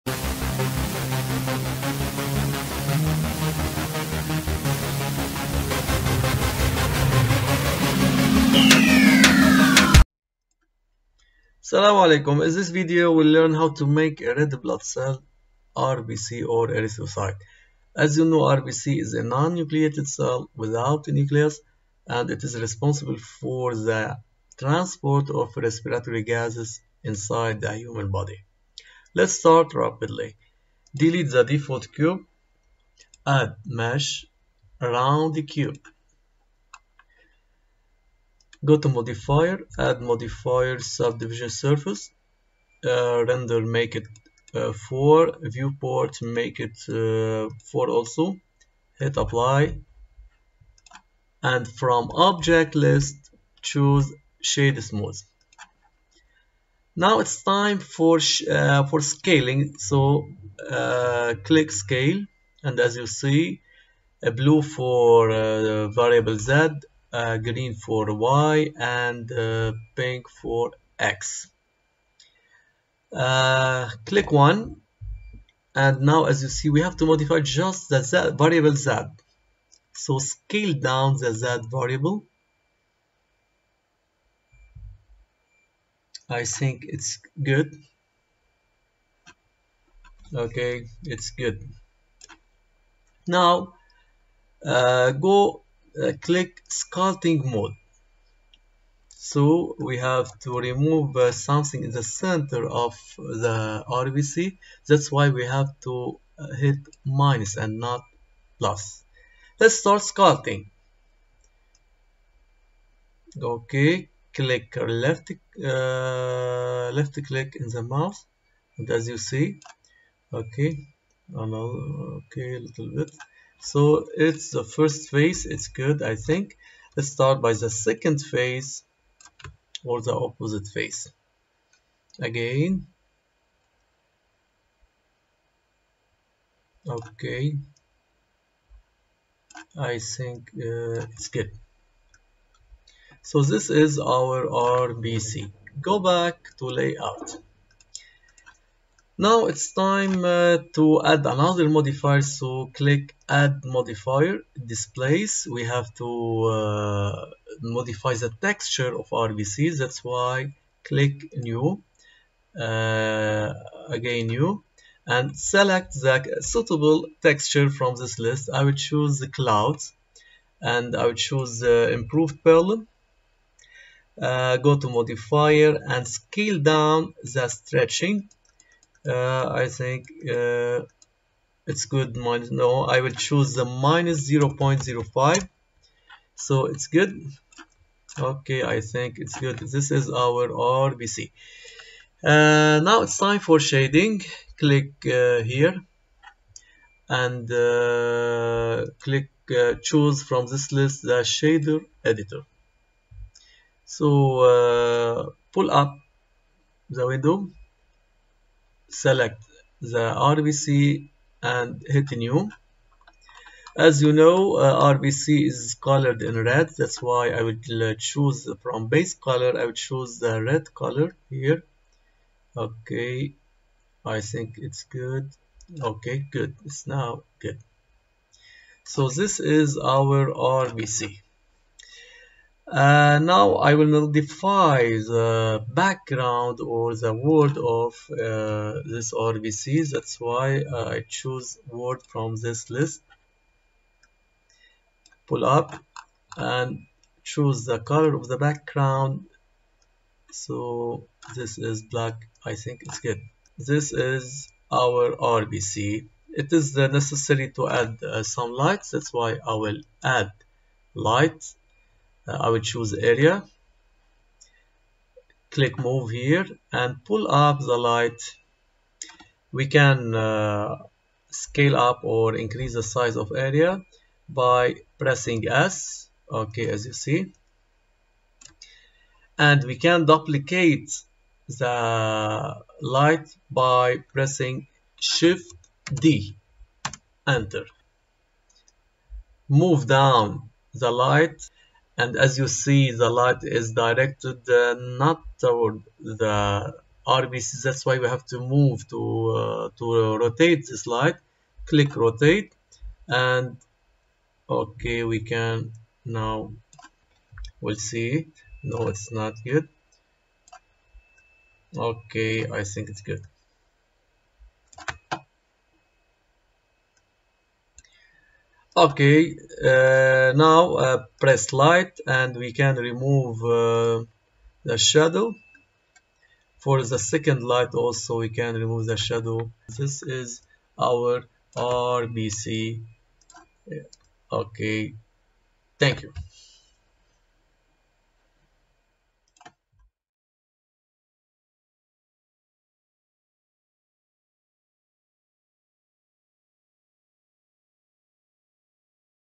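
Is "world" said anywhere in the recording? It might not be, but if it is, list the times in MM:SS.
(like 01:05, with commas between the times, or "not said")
03:57, 04:01.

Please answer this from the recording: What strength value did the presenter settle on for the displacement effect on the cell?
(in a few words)
-0.05.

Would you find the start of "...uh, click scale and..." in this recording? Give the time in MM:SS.
01:00.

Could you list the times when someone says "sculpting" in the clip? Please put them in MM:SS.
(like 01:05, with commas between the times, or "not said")
01:36, 01:50.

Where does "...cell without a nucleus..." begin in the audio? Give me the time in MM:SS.
00:20.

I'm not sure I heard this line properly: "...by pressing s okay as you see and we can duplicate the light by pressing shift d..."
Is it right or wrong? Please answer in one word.
right.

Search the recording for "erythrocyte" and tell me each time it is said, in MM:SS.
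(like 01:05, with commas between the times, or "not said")
00:16.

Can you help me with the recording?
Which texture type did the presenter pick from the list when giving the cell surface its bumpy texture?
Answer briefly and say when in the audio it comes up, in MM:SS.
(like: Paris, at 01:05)
clouds, at 02:49.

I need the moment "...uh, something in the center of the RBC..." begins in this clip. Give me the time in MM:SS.
01:41.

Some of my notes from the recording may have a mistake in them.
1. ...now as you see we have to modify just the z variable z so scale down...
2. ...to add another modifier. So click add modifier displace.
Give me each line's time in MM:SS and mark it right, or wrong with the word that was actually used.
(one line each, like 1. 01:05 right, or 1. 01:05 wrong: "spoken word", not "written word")
1. 01:16 right
2. 02:30 right.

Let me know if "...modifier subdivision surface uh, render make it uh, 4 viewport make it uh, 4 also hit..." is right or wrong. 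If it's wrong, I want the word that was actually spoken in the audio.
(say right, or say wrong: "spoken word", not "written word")
right.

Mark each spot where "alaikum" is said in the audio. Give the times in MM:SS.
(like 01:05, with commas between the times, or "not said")
00:11.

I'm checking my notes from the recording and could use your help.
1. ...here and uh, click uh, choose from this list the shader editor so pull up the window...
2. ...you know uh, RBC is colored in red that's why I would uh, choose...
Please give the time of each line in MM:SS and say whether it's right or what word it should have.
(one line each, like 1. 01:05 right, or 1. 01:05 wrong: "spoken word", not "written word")
1. 03:15 right
2. 03:34 right.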